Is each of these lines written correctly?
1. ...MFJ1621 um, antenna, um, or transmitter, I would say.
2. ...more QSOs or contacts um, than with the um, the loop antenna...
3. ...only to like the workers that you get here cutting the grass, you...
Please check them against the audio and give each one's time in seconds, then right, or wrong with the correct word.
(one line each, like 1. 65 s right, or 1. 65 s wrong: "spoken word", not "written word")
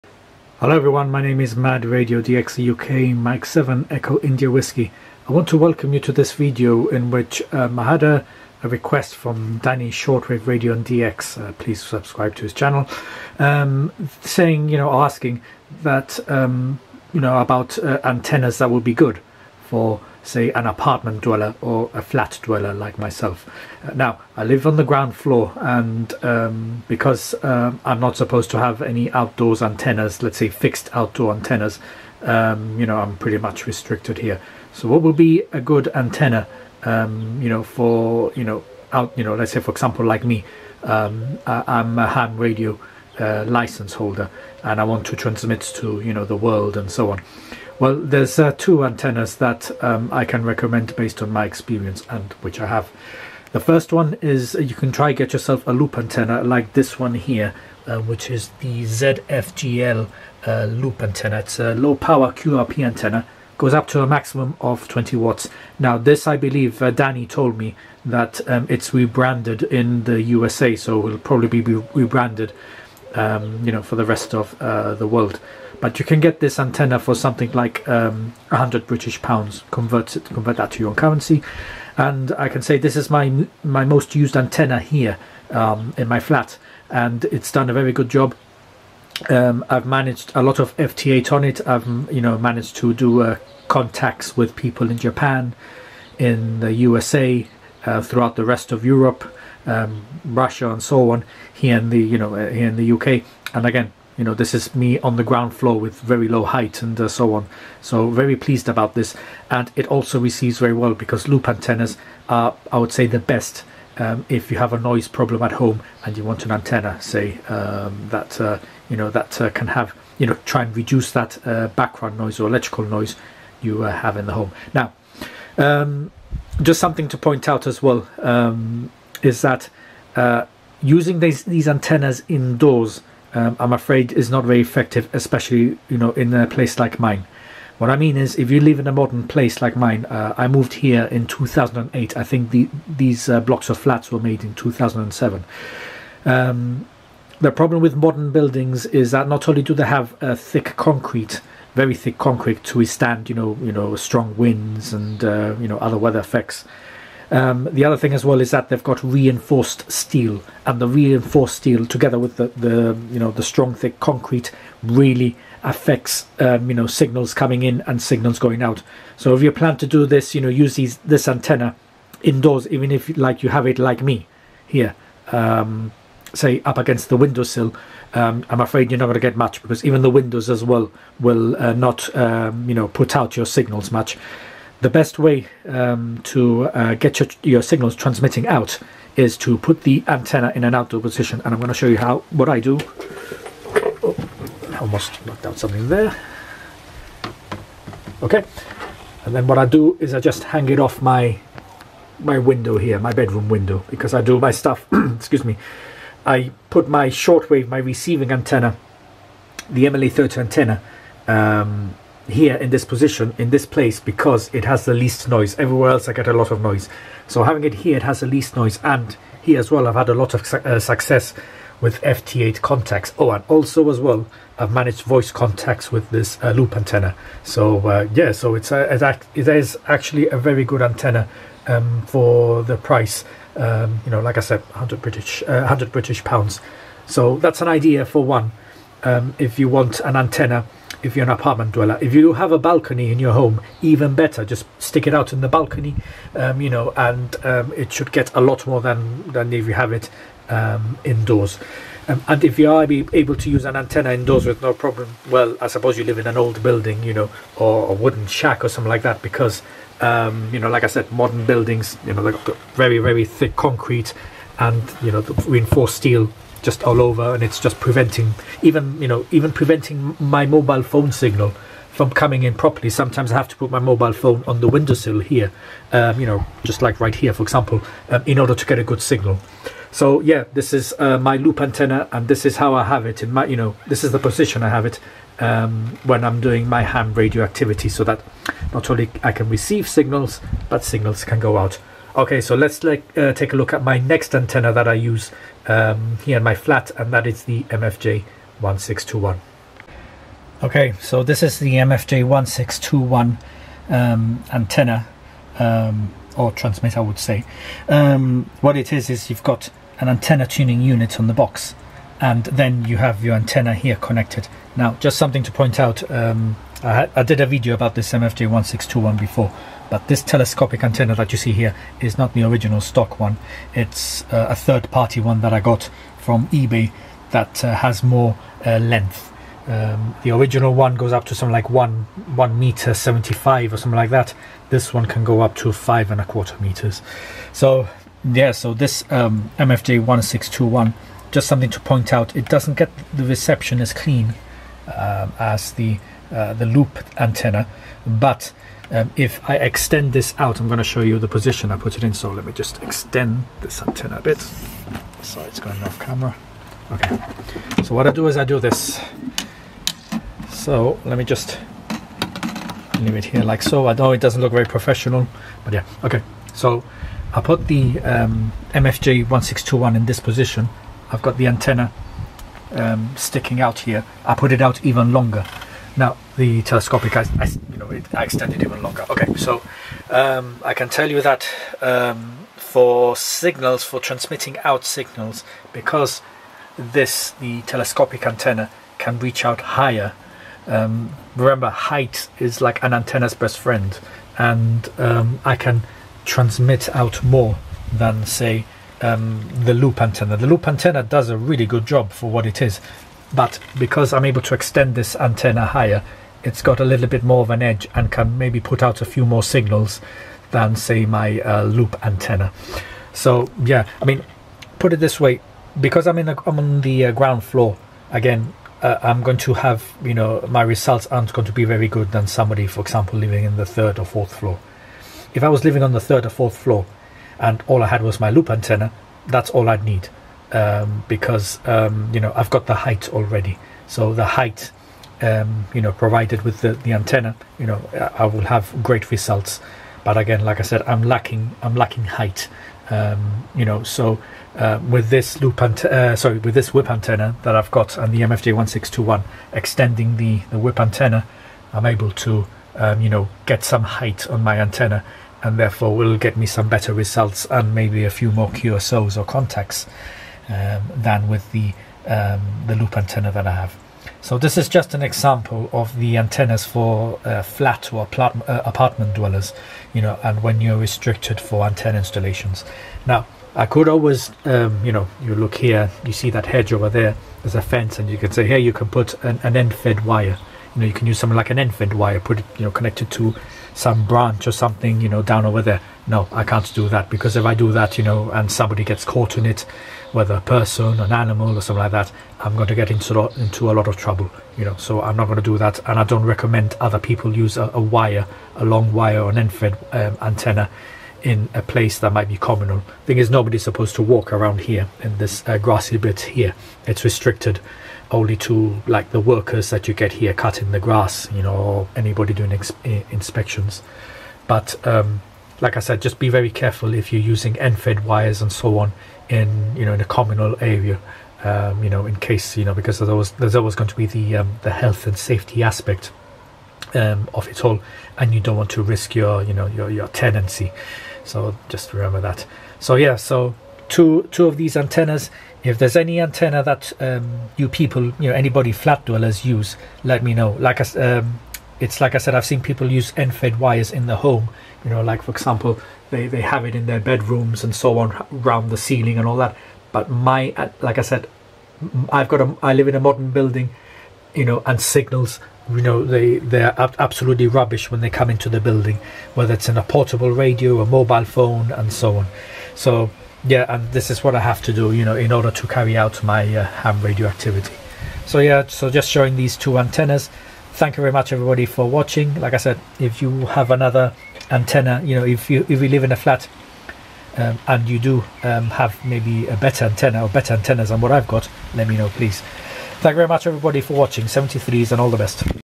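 1. 301 s right
2. 458 s right
3. 508 s right.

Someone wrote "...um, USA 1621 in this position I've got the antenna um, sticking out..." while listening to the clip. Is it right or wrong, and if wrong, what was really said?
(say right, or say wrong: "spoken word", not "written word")
wrong: "MFJ", not "USA".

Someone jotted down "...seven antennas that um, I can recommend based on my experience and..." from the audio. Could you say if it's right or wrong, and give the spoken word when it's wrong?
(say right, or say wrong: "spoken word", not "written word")
wrong: "two", not "seven".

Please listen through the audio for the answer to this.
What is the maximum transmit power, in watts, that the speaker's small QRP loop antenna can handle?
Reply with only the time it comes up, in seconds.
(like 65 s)
64 s.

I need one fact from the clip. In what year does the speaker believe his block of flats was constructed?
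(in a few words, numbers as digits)
2007.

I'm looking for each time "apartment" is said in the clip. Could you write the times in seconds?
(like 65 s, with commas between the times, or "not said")
20 s, 241 s, 468 s.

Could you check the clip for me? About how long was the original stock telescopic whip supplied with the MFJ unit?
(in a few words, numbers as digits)
1.75 meters.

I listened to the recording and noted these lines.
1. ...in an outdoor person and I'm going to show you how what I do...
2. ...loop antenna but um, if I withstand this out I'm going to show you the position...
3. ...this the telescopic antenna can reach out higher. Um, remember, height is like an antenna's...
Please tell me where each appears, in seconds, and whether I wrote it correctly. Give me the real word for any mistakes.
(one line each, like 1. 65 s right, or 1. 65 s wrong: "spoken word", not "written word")
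1. 190 s wrong: "position", not "person"
2. 346 s wrong: "extend", not "withstand"
3. 386 s right.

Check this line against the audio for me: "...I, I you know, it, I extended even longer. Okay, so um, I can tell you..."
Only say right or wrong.
right.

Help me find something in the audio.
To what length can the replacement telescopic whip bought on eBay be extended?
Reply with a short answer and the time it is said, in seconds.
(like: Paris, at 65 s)
5.25 meters, at 335 s.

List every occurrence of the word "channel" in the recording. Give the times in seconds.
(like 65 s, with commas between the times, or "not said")
12 s.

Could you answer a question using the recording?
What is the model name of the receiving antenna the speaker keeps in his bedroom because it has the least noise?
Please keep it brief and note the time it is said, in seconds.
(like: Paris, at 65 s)
MLA 30, at 209 s.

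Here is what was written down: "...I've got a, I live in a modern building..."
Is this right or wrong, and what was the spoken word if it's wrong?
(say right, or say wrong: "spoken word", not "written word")
right.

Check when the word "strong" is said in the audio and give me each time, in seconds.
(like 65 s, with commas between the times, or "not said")
153 s, 163 s.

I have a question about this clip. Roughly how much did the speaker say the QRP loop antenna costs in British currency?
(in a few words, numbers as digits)
100 British pounds.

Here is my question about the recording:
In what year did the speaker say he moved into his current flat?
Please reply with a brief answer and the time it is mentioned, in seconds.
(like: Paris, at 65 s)
2008, at 141 s.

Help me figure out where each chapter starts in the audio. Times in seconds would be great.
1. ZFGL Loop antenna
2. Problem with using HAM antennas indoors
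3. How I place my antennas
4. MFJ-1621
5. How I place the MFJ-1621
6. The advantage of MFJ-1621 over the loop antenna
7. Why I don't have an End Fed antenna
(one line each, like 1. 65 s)
1. 56 s
2. 125 s
3. 194 s
4. 300 s
5. 353 s
6. 385 s
7. 473 s.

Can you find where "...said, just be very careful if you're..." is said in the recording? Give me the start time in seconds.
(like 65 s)
515 s.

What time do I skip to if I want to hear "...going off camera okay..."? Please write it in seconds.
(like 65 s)
355 s.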